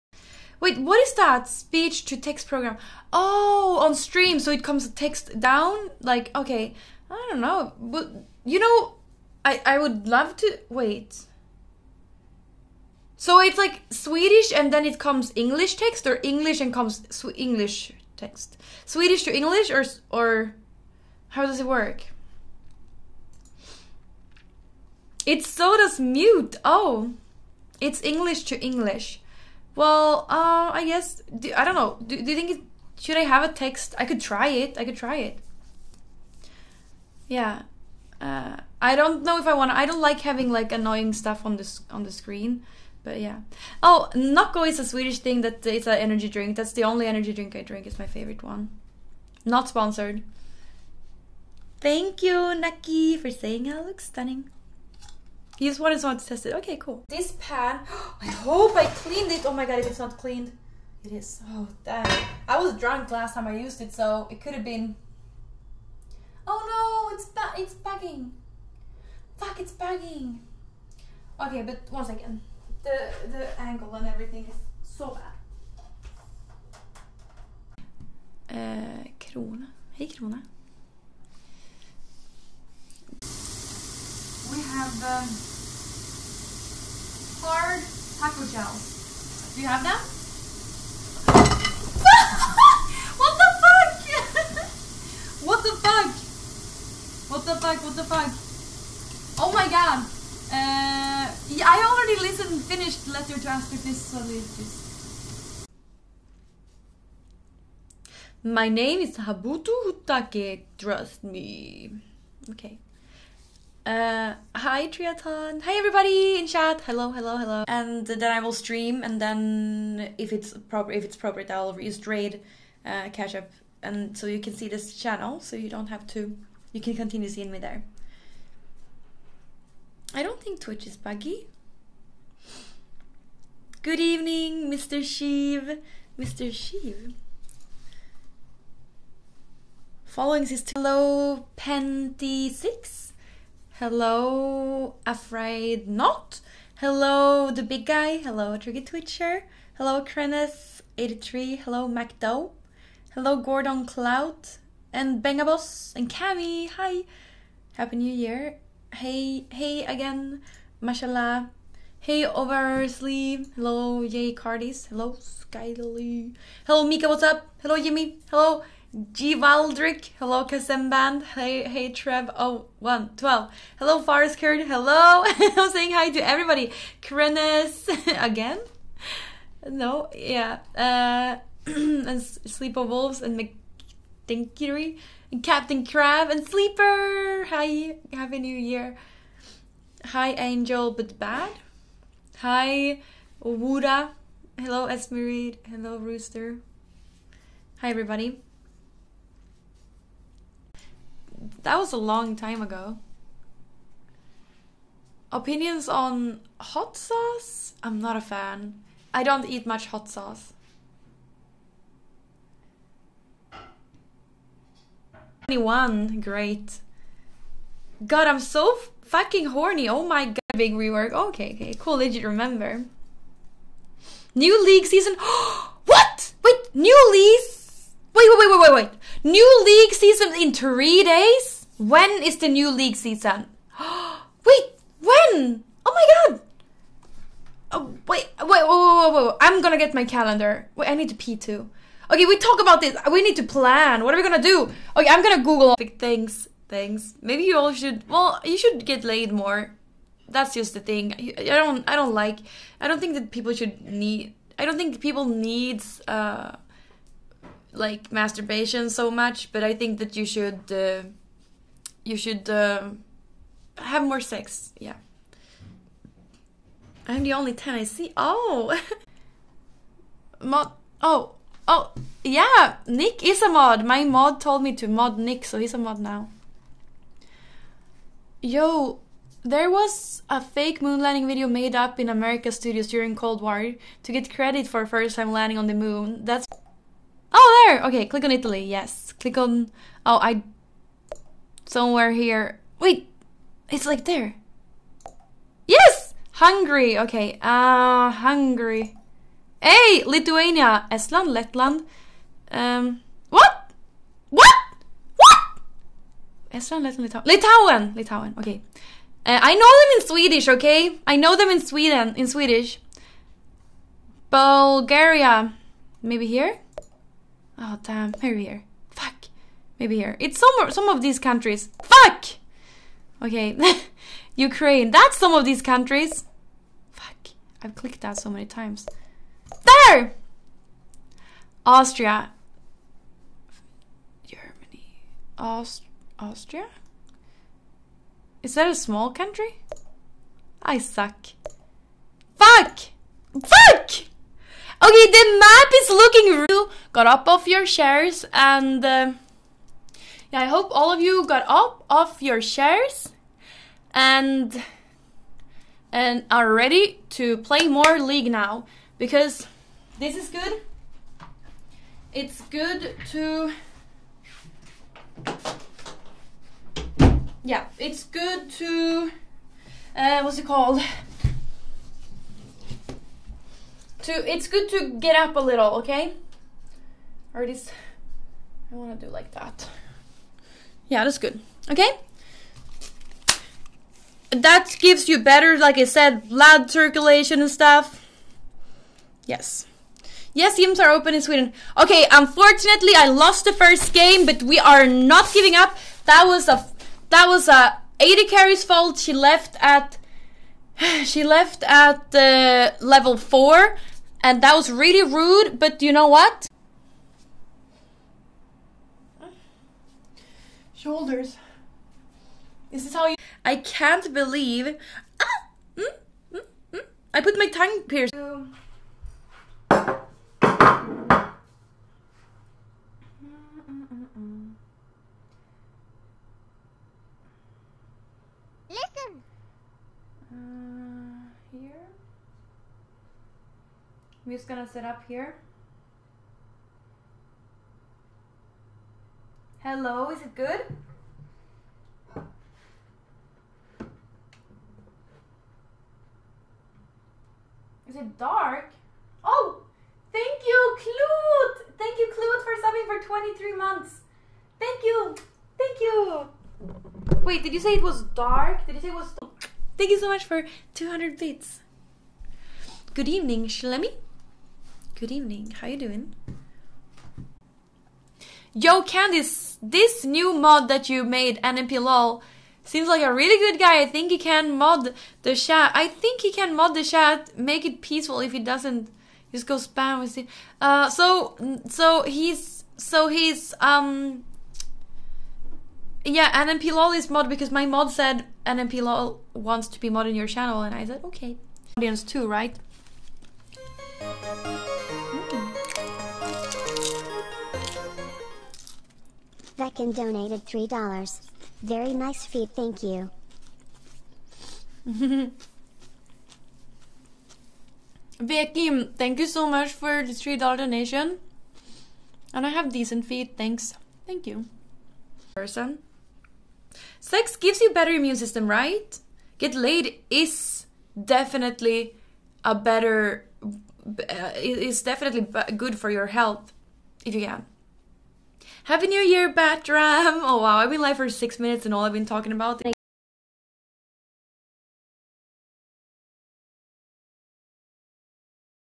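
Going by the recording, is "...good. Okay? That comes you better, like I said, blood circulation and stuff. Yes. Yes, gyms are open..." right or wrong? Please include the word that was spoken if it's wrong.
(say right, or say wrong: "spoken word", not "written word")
wrong: "gives", not "comes".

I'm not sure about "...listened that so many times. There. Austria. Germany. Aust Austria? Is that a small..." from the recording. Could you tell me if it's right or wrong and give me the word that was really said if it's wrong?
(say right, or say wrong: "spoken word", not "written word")
wrong: "clicked", not "listened".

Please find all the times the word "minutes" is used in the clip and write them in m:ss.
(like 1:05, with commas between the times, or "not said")
8:51.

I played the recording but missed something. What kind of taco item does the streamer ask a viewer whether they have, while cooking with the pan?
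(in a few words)
hard taco gel.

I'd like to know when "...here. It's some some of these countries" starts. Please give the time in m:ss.
5:19.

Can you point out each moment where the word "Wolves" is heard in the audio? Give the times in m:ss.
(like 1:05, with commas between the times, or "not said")
3:02.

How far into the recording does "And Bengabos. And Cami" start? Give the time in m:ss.
2:34.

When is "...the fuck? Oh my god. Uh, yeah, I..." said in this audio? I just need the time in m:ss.
1:37.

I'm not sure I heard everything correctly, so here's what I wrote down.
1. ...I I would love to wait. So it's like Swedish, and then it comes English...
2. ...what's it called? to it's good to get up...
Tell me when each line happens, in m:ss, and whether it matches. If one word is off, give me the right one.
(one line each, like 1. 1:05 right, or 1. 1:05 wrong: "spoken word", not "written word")
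1. 0:09 right
2. 6:10 right.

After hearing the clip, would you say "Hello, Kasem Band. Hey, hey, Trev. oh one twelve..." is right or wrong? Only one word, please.
right.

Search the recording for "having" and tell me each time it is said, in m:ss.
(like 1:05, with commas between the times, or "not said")
0:40.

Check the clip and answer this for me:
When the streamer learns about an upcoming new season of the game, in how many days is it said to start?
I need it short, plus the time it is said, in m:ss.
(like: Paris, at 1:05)
3 days, at 3:50.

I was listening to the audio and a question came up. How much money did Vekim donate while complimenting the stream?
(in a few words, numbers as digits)
$3.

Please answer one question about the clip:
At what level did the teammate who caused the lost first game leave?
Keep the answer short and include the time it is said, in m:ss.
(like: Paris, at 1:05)
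level 4, at 6:42.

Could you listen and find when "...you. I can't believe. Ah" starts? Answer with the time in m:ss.
6:53.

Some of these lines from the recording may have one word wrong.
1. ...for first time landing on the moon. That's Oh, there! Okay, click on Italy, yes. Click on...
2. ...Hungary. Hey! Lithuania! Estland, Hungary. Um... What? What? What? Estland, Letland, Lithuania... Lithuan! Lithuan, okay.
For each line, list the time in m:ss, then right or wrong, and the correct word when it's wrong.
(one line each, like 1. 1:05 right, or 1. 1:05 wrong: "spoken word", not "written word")
1. 4:44 right
2. 4:58 wrong: "Letland", not "Hungary".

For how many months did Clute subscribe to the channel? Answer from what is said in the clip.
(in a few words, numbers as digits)
23.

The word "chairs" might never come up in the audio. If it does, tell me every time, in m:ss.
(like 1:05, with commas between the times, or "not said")
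5:47, 5:52.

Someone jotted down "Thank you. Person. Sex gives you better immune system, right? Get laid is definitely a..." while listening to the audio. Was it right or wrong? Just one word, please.
right.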